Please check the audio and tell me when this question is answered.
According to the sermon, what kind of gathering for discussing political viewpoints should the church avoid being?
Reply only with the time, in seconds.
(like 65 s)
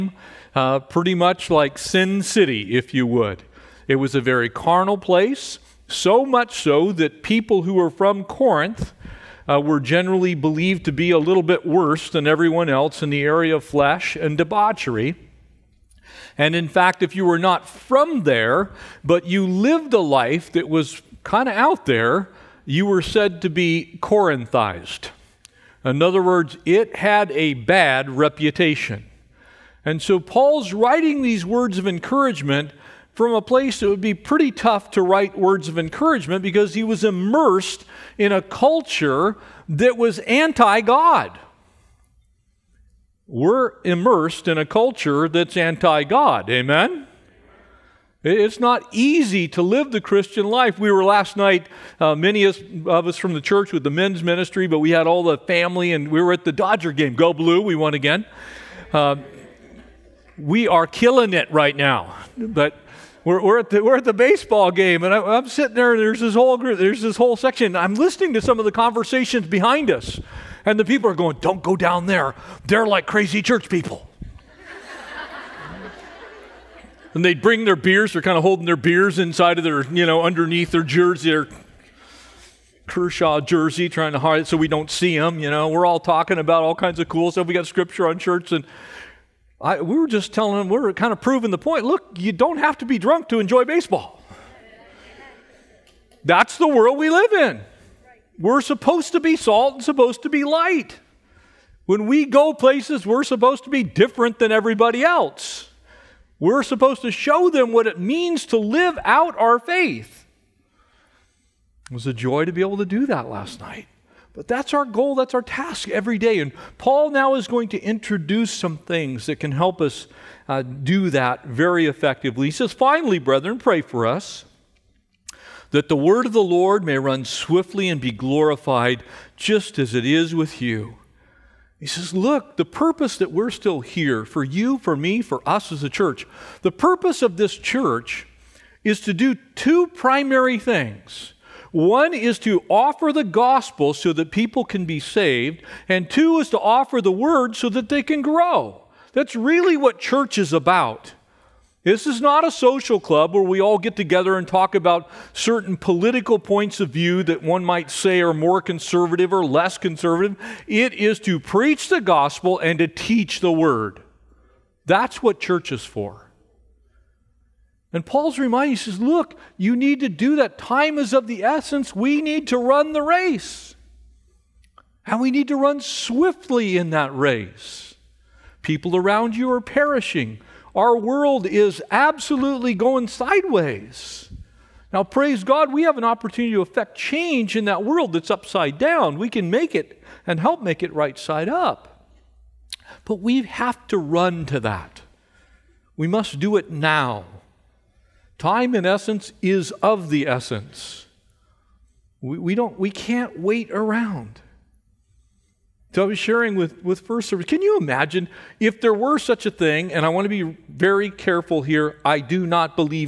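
152 s.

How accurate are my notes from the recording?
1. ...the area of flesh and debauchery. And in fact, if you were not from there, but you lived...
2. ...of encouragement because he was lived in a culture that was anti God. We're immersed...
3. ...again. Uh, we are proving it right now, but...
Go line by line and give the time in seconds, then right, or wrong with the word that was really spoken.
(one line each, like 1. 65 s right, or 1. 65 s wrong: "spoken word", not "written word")
1. 13 s right
2. 35 s wrong: "immersed", not "lived"
3. 57 s wrong: "killing", not "proving".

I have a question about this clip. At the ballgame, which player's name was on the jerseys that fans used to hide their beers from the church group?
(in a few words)
Kershaw.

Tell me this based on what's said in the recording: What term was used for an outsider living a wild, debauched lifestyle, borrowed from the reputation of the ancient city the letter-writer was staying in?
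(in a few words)
Corinthized.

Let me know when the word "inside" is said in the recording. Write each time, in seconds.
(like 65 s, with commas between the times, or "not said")
79 s.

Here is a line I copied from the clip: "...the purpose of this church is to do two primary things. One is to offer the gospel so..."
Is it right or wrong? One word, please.
right.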